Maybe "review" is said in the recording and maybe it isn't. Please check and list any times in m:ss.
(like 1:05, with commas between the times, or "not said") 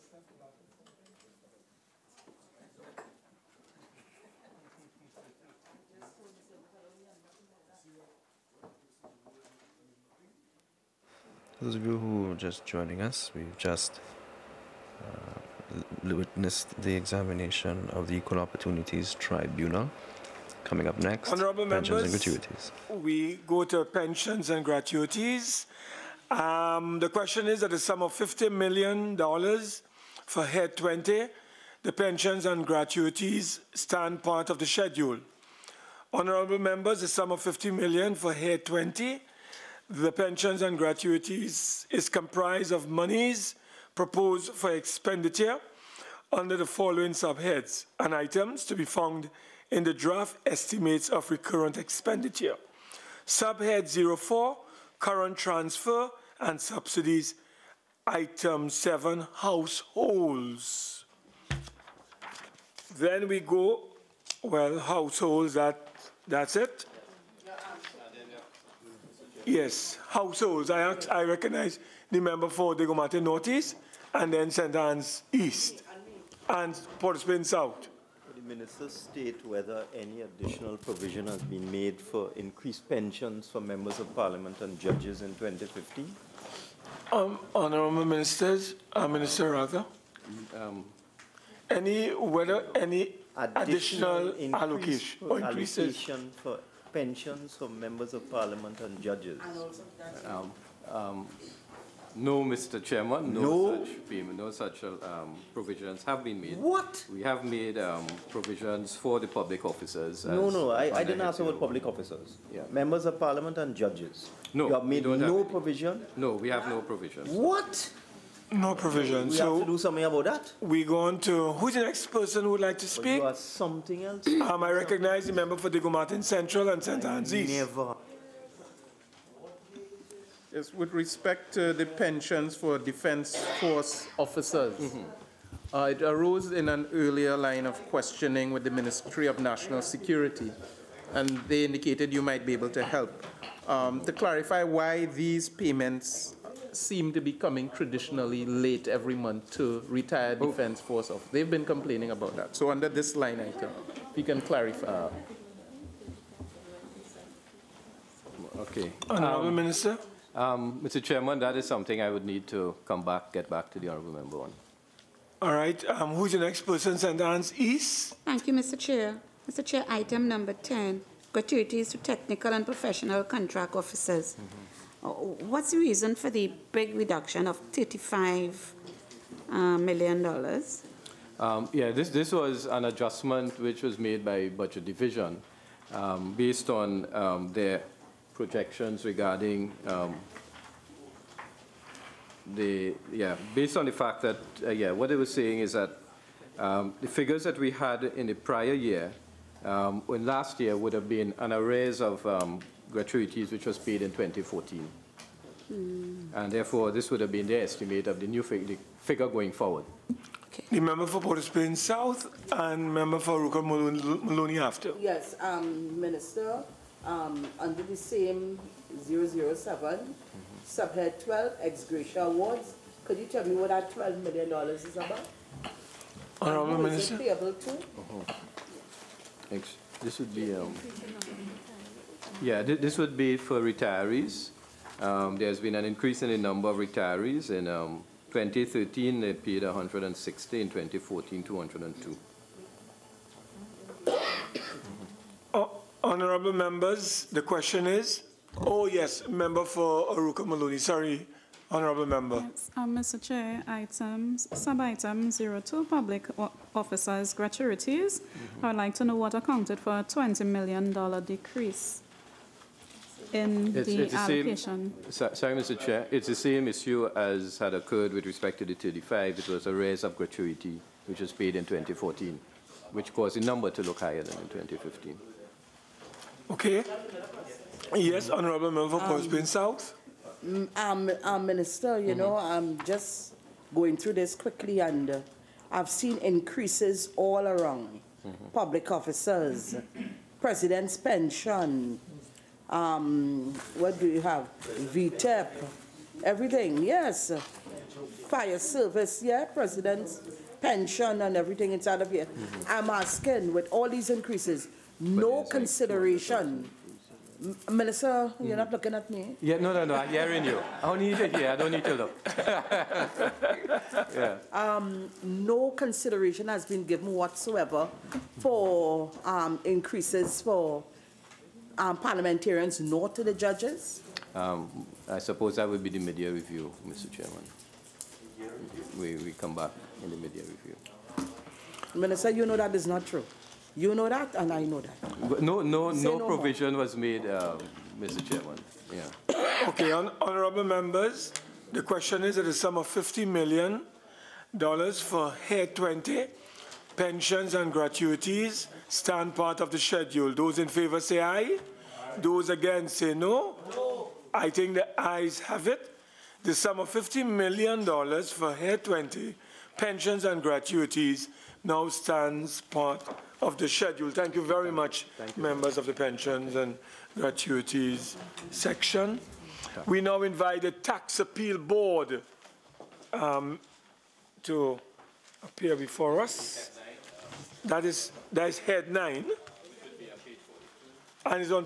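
5:26, 5:30.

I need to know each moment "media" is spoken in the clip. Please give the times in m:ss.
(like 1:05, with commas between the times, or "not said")
5:25, 5:30.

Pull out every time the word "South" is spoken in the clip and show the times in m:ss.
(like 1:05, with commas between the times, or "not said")
1:17, 3:31, 4:39.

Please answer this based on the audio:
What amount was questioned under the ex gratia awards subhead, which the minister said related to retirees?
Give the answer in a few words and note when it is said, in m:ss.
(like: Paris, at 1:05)
$12 million, at 3:43.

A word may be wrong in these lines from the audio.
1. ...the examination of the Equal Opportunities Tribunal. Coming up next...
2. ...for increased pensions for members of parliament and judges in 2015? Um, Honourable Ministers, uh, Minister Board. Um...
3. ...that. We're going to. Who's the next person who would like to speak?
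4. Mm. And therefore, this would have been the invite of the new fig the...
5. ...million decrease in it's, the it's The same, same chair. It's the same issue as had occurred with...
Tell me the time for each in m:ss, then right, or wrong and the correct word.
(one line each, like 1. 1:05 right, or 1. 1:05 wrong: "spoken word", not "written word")
1. 0:16 right
2. 1:22 wrong: "Rather", not "Board"
3. 2:00 right
4. 3:25 wrong: "estimate", not "invite"
5. 4:20 right.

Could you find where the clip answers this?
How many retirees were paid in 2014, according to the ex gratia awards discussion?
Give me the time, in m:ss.
4:01.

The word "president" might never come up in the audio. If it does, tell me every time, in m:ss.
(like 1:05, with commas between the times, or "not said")
4:50, 4:59.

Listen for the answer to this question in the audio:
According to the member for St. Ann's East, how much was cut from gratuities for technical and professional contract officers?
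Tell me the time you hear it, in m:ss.
2:57.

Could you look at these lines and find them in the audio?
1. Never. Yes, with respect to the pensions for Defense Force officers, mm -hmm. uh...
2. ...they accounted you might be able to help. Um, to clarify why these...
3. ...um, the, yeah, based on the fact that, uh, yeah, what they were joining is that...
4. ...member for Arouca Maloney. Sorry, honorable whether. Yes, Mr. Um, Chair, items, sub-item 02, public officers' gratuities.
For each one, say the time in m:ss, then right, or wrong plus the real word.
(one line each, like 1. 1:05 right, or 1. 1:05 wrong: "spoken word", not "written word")
1. 2:07 right
2. 2:21 wrong: "indicated", not "accounted"
3. 3:09 wrong: "saying", not "joining"
4. 4:09 wrong: "member", not "whether".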